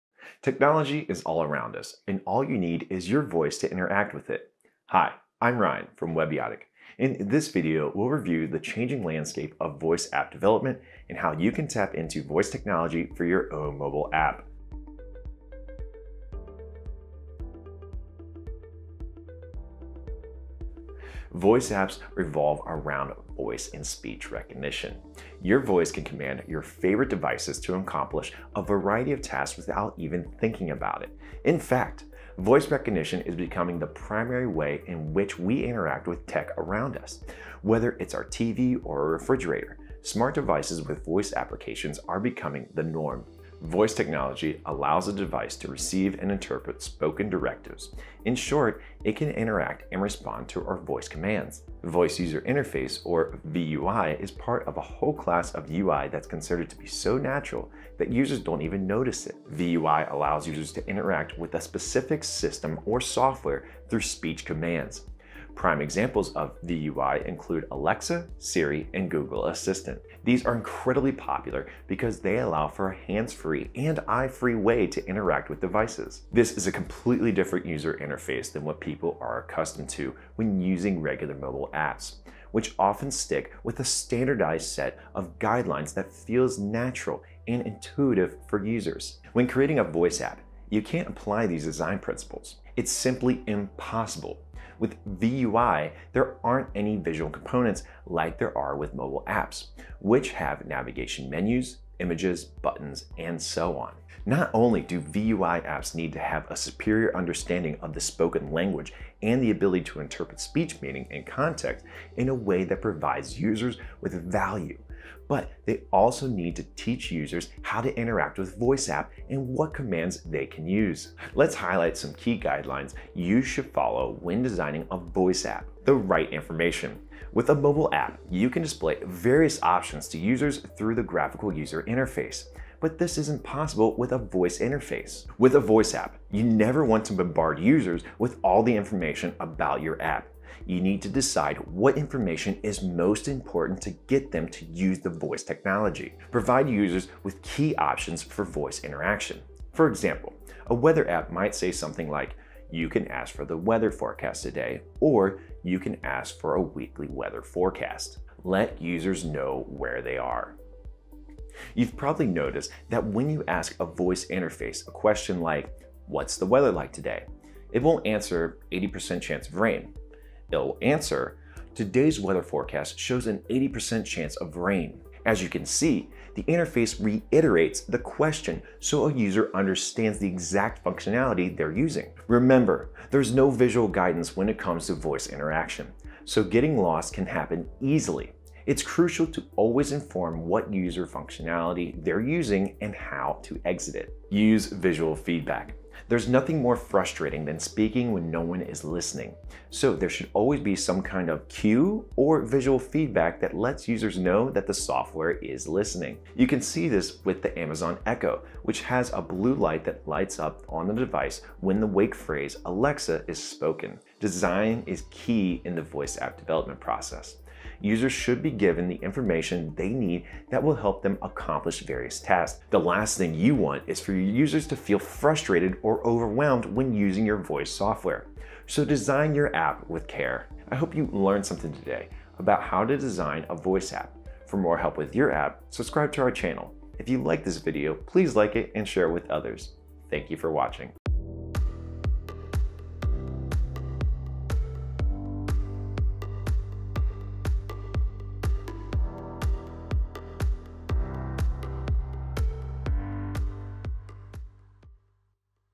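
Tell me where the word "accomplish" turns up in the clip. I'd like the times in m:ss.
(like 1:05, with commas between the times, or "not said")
0:27, 3:41.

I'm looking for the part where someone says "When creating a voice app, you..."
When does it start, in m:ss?
1:29.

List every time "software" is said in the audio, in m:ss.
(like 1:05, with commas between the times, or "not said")
1:02, 3:24, 3:47.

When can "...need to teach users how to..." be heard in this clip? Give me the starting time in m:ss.
1:56.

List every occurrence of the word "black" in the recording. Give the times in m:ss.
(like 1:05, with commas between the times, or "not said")
not said.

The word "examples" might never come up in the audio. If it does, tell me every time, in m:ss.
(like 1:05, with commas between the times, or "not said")
1:05, 2:29.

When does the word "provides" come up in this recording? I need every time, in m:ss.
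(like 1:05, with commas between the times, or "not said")
1:52, 2:26.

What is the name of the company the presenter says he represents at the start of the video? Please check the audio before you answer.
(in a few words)
Webiotic.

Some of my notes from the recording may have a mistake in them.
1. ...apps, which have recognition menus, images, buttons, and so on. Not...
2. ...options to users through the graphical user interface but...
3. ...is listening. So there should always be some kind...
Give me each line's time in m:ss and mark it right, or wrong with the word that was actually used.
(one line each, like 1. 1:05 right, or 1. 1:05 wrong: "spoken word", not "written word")
1. 1:39 wrong: "navigation", not "recognition"
2. 2:09 right
3. 3:18 right.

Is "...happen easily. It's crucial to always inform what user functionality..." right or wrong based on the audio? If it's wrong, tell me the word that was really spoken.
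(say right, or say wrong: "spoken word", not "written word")
right.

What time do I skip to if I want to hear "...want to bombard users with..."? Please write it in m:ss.
2:16.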